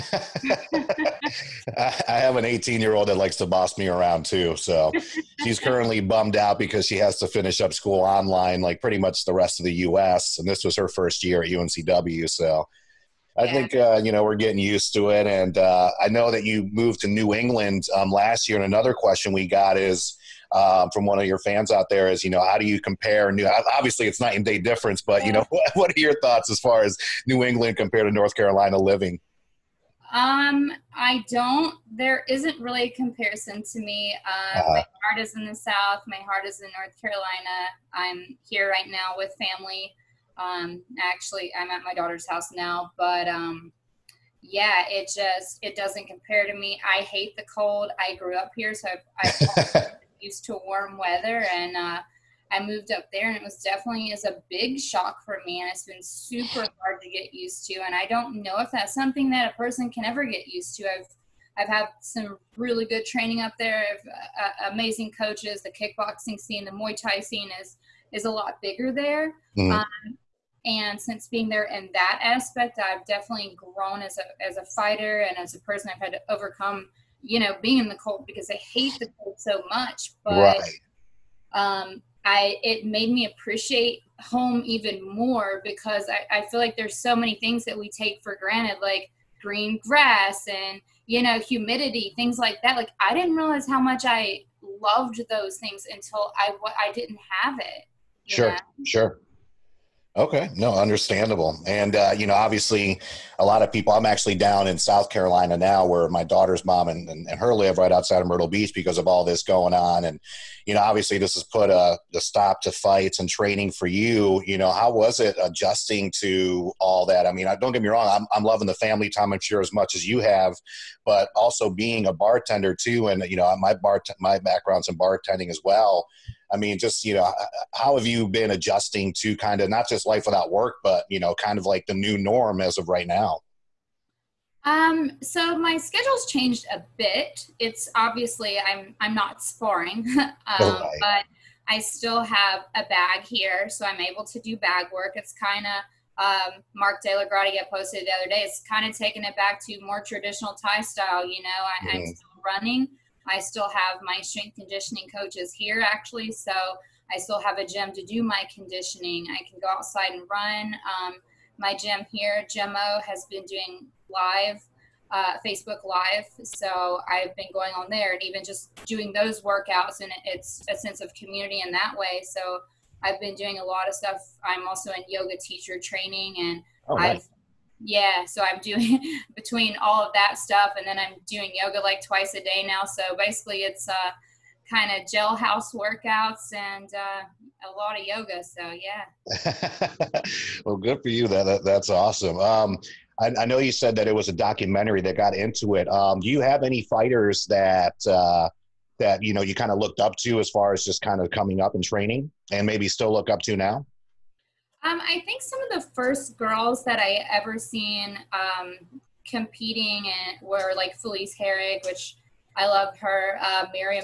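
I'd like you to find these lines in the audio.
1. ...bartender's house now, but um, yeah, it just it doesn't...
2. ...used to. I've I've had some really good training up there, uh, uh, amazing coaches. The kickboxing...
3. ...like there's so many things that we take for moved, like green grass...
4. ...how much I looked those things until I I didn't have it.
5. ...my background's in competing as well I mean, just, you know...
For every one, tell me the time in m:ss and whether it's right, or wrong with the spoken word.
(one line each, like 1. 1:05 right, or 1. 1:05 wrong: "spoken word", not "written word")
1. 0:41 wrong: "daughter", not "bartender"
2. 1:00 right
3. 1:26 wrong: "granted", not "moved"
4. 1:33 wrong: "loved", not "looked"
5. 2:04 wrong: "bartending", not "competing".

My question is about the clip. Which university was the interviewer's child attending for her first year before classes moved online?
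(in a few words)
UNCW.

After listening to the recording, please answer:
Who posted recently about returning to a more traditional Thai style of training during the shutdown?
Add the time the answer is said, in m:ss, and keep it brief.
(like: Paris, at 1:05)
Mark DellaGrotte, at 2:26.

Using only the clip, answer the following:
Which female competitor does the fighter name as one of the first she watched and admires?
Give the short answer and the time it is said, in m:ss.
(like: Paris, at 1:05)
Felice Herrig, at 3:30.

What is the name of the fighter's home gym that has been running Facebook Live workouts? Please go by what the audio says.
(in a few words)
Gemo.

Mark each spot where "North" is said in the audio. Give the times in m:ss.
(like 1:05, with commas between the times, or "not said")
0:28, 0:36.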